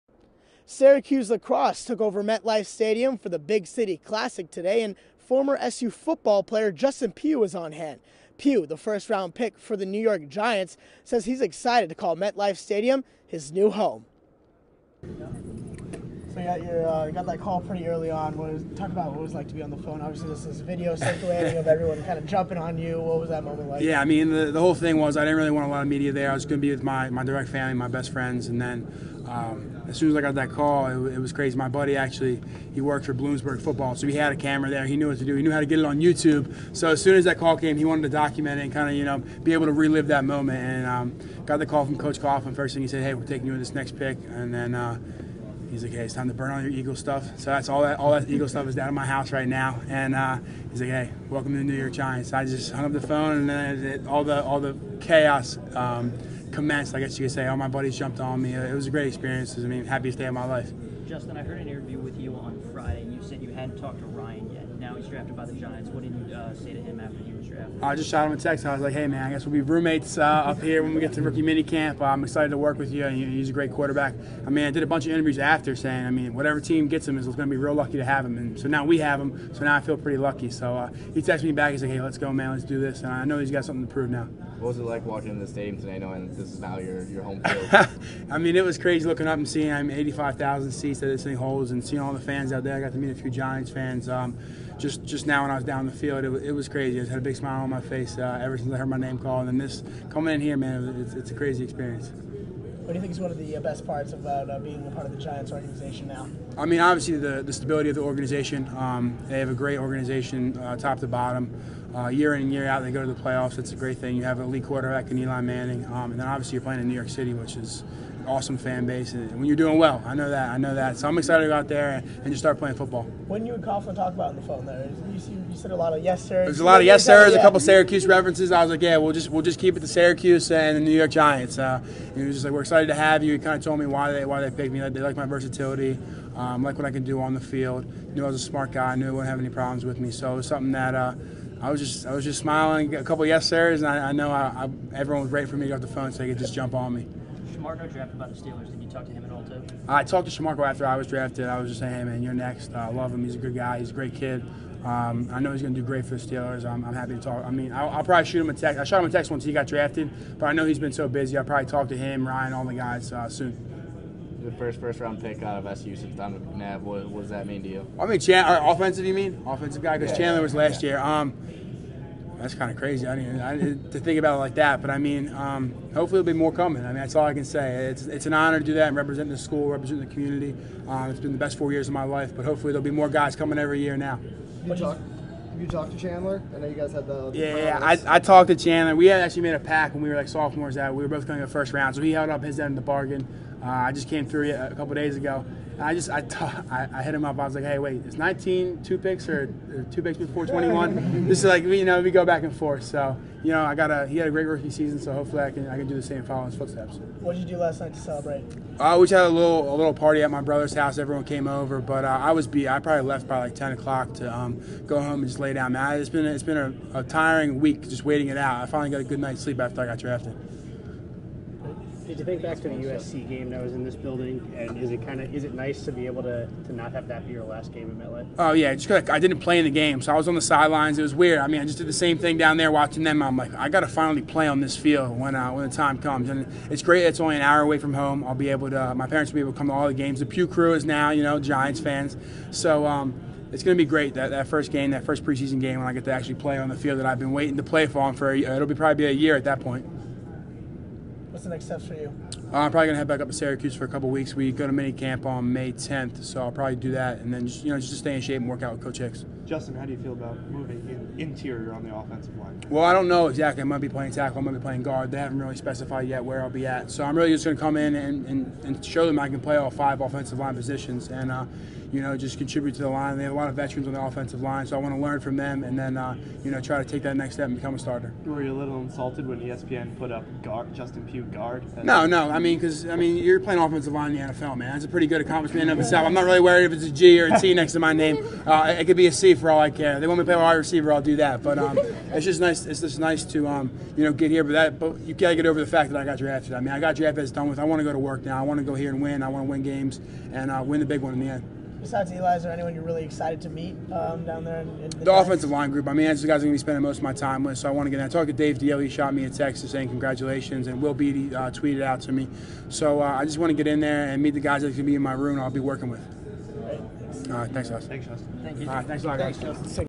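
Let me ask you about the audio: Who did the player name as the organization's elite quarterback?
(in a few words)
Eli Manning.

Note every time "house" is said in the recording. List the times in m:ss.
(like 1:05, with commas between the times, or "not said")
0:49, 3:30.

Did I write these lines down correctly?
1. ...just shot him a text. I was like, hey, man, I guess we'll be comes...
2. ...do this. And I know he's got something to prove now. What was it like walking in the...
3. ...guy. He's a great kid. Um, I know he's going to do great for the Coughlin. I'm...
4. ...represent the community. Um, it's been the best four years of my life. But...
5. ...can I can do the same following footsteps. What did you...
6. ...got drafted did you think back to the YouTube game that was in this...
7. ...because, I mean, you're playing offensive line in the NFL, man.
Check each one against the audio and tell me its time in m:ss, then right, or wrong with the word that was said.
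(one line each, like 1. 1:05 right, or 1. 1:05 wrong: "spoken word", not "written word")
1. 1:07 wrong: "roommates", not "comes"
2. 1:22 right
3. 2:33 wrong: "Steelers", not "Coughlin"
4. 2:59 right
5. 3:25 right
6. 3:39 wrong: "USC", not "YouTube"
7. 4:42 right.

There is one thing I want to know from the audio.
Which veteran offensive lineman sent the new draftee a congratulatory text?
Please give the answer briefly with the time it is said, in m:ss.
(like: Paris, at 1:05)
Dave Diehl, at 5:08.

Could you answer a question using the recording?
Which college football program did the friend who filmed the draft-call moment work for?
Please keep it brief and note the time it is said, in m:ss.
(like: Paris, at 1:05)
Bloomsburg, at 0:33.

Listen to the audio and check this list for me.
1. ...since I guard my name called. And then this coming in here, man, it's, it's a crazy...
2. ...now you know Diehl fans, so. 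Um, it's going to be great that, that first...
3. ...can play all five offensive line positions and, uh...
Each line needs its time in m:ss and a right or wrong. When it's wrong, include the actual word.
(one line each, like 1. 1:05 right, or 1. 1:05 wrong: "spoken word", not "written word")
1. 1:38 wrong: "heard", not "guard"
2. 4:00 wrong: "Giants", not "Diehl"
3. 4:29 right.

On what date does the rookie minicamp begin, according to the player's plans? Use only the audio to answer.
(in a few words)
May 10th.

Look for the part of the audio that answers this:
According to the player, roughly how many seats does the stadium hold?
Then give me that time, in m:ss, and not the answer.
1:29.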